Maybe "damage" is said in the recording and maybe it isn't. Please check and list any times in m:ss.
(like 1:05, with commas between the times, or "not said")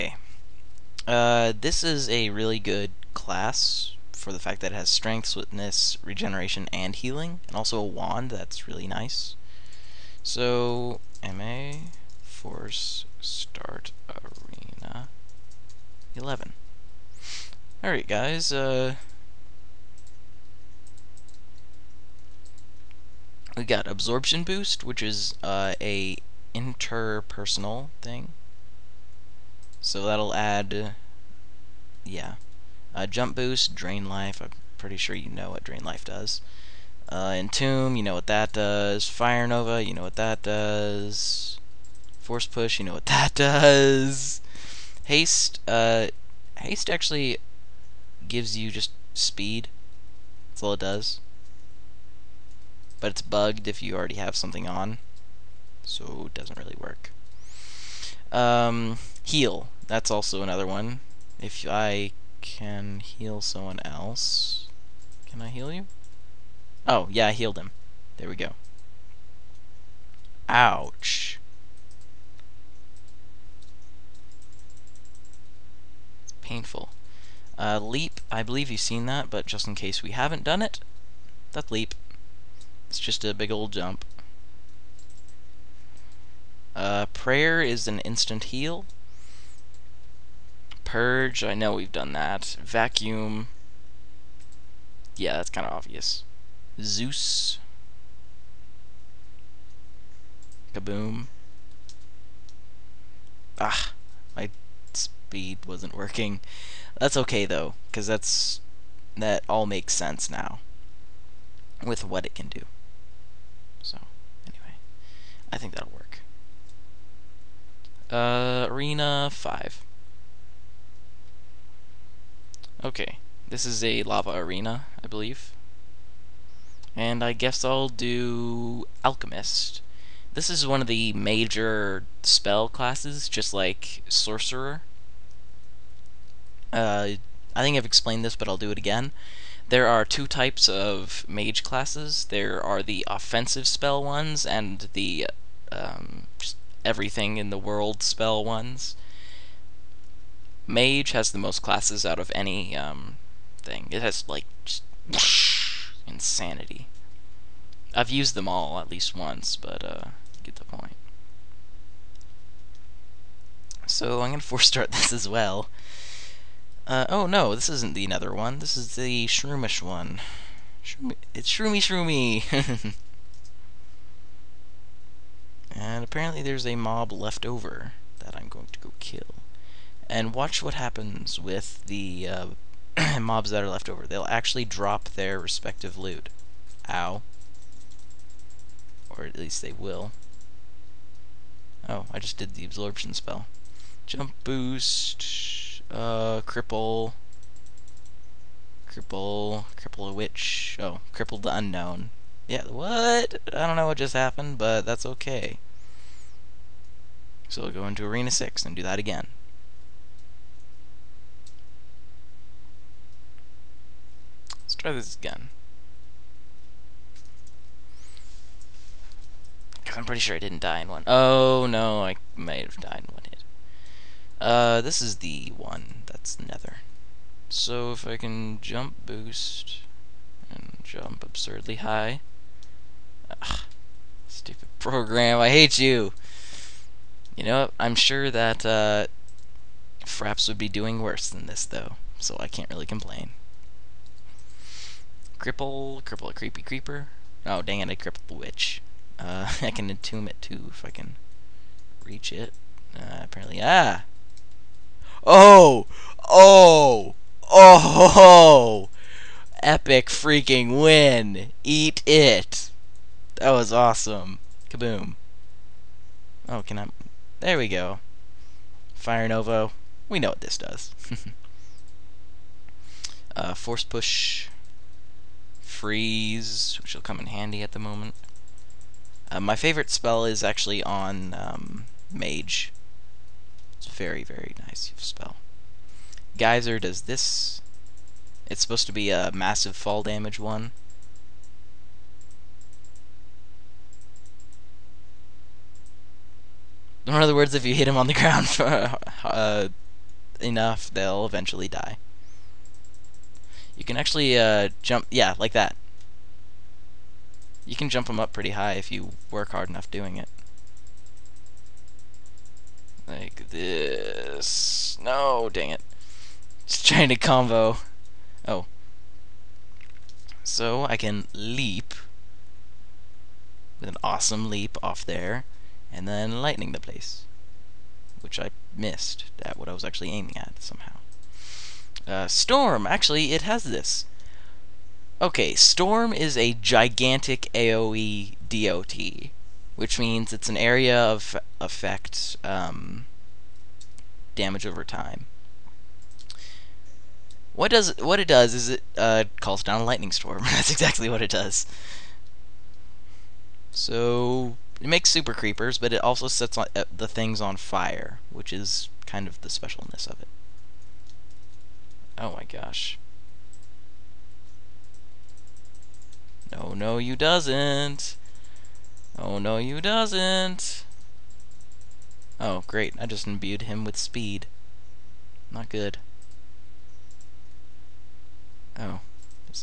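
4:50, 5:44.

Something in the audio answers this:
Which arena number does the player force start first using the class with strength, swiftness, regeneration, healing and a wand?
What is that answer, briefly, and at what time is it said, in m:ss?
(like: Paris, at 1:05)
11, at 0:16.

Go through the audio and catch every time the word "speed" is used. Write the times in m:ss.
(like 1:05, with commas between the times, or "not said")
0:49, 1:44, 6:13.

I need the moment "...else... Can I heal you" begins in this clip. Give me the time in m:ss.
1:03.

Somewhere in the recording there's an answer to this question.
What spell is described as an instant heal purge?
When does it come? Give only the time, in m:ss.
1:27.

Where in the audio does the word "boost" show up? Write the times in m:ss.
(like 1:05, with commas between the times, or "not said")
0:24, 0:33, 3:14, 3:49.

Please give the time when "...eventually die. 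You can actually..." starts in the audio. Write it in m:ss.
5:01.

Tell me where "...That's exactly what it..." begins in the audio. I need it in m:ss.
5:50.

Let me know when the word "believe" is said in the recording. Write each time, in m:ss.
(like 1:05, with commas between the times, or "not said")
1:18, 2:05.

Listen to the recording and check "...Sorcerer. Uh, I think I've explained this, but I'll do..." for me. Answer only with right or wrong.
right.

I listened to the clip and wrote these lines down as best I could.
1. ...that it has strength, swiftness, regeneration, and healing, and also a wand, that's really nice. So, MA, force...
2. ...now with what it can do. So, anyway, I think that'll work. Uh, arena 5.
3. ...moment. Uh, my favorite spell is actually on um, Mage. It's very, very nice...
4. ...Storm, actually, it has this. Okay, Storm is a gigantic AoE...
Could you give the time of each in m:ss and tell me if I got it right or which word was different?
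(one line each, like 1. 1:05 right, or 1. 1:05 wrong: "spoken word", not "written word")
1. 0:04 right
2. 1:50 right
3. 4:37 right
4. 5:32 right.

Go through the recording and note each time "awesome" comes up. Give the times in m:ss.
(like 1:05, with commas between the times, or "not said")
4:23, 5:24.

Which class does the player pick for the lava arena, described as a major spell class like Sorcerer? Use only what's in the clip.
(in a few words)
Alchemist.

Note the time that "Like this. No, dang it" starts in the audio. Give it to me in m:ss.
5:13.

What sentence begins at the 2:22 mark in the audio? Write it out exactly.
There are the offensive spell ones and the um, everything in the world spell ones.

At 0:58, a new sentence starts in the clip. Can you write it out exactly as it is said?
Um, heal, that's also another one.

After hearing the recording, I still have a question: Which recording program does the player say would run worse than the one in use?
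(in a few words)
Fraps.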